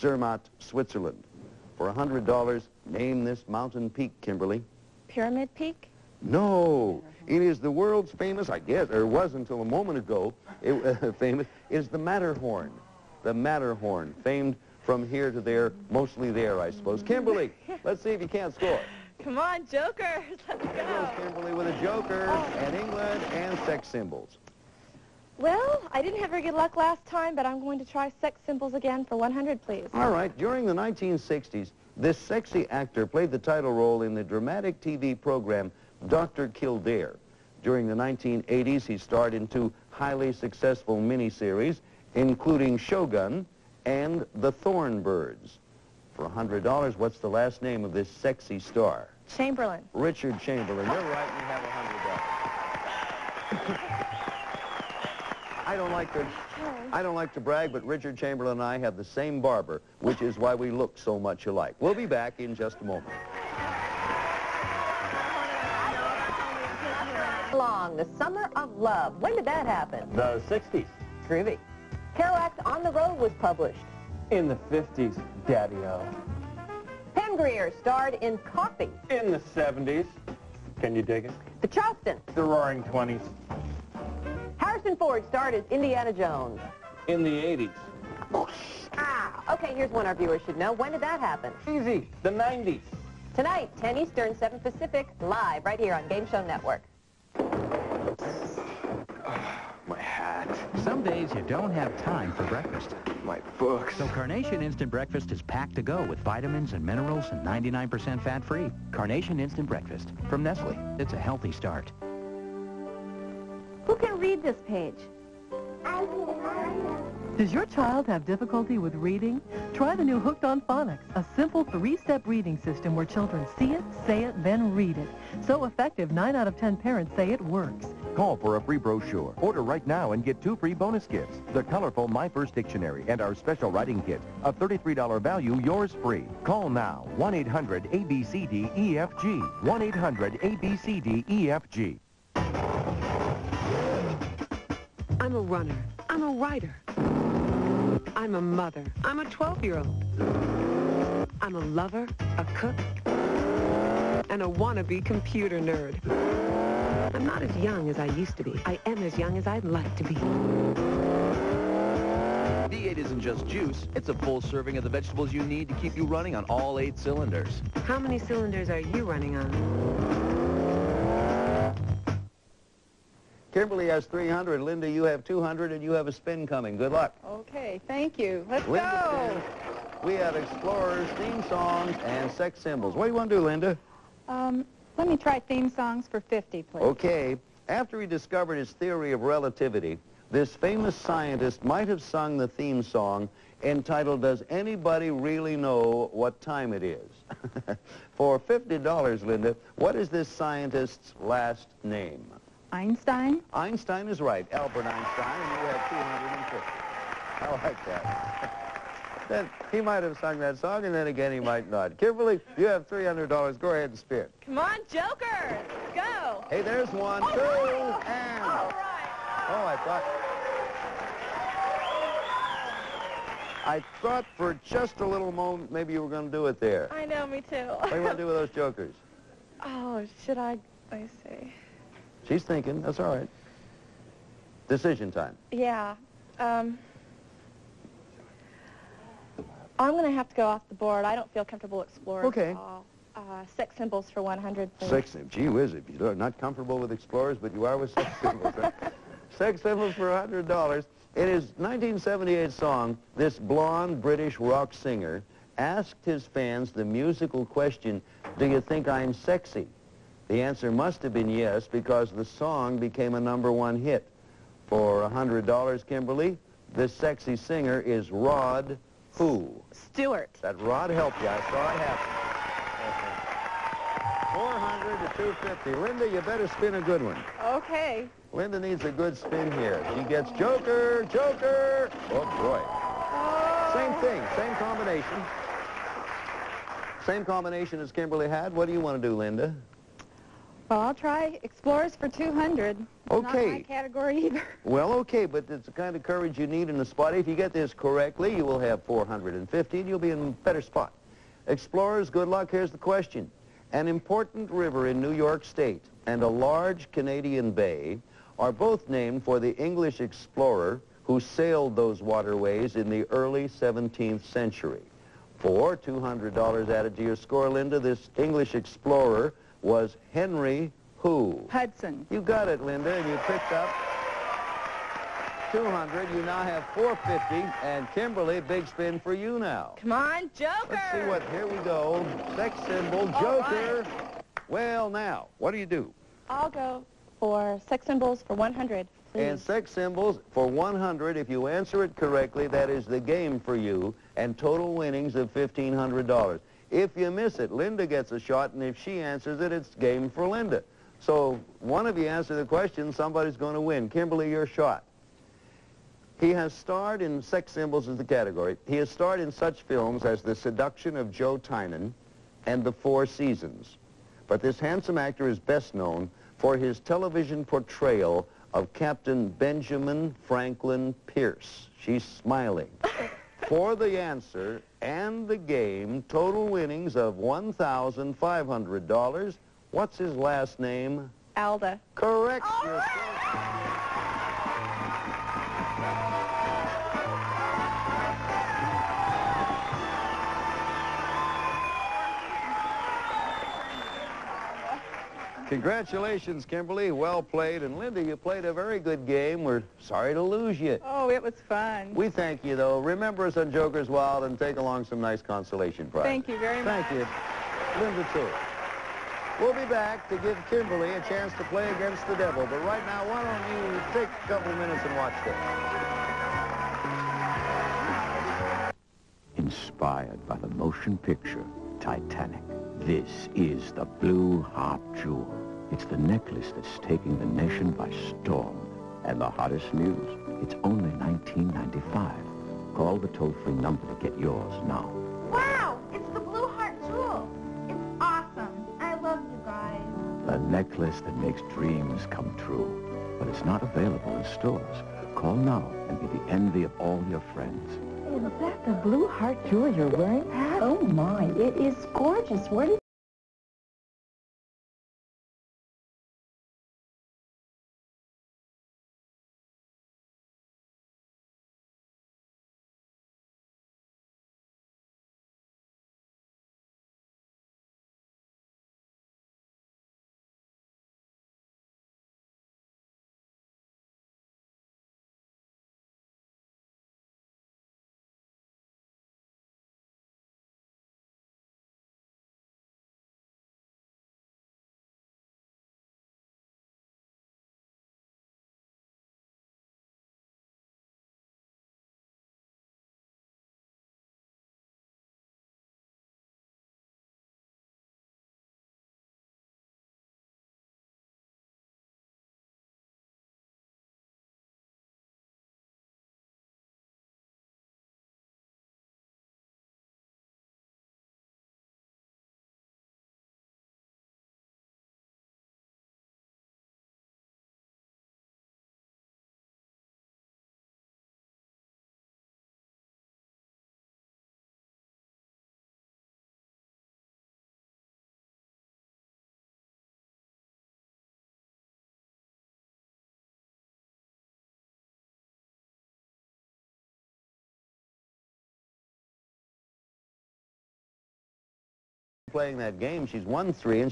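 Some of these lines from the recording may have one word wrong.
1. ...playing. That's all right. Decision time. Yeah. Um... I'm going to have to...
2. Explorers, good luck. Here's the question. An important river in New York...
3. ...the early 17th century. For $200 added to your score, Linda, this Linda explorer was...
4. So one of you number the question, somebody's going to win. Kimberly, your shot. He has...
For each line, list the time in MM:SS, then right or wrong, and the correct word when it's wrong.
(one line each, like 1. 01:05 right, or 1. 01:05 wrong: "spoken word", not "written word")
1. 03:52 wrong: "thinking", not "playing"
2. 05:01 right
3. 05:12 wrong: "English", not "Linda"
4. 05:50 wrong: "answer", not "number".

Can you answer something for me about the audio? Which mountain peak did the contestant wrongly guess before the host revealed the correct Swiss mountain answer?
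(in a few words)
Pyramid Peak.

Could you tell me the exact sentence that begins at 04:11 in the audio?
In his 1978 song, this blonde British rock singer asked his fans the musical question, do you think I'm sexy?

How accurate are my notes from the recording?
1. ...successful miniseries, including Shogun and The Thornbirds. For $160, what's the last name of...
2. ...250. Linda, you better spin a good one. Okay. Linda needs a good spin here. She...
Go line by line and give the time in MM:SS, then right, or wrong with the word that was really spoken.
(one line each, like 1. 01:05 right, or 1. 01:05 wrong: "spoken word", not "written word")
1. 00:40 wrong: "100", not "160"
2. 04:35 right.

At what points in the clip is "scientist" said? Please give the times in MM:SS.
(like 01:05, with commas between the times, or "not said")
03:10, 03:20.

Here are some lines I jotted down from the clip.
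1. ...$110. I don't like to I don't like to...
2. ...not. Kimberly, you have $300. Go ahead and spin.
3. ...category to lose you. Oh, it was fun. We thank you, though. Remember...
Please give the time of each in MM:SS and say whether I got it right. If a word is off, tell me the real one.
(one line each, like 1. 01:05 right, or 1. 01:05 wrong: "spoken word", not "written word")
1. 00:53 wrong: "100", not "110"
2. 03:31 right
3. 06:39 wrong: "sorry", not "category".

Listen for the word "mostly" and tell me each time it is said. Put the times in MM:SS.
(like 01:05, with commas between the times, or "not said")
00:15.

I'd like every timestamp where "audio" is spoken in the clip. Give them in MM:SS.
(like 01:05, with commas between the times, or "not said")
not said.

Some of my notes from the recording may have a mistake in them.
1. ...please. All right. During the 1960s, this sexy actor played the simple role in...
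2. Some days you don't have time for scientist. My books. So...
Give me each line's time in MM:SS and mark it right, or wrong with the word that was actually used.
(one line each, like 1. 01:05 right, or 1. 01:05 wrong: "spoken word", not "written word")
1. 00:29 wrong: "title", not "simple"
2. 01:40 wrong: "breakfast", not "scientist".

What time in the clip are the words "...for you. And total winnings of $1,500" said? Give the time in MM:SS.
05:43.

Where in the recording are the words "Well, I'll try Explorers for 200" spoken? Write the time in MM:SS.
04:50.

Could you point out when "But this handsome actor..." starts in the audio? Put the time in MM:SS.
06:04.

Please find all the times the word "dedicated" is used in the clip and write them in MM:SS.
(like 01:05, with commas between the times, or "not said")
not said.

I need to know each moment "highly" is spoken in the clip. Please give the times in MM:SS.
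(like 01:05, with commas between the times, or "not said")
00:39.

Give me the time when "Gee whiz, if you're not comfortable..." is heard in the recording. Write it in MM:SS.
04:05.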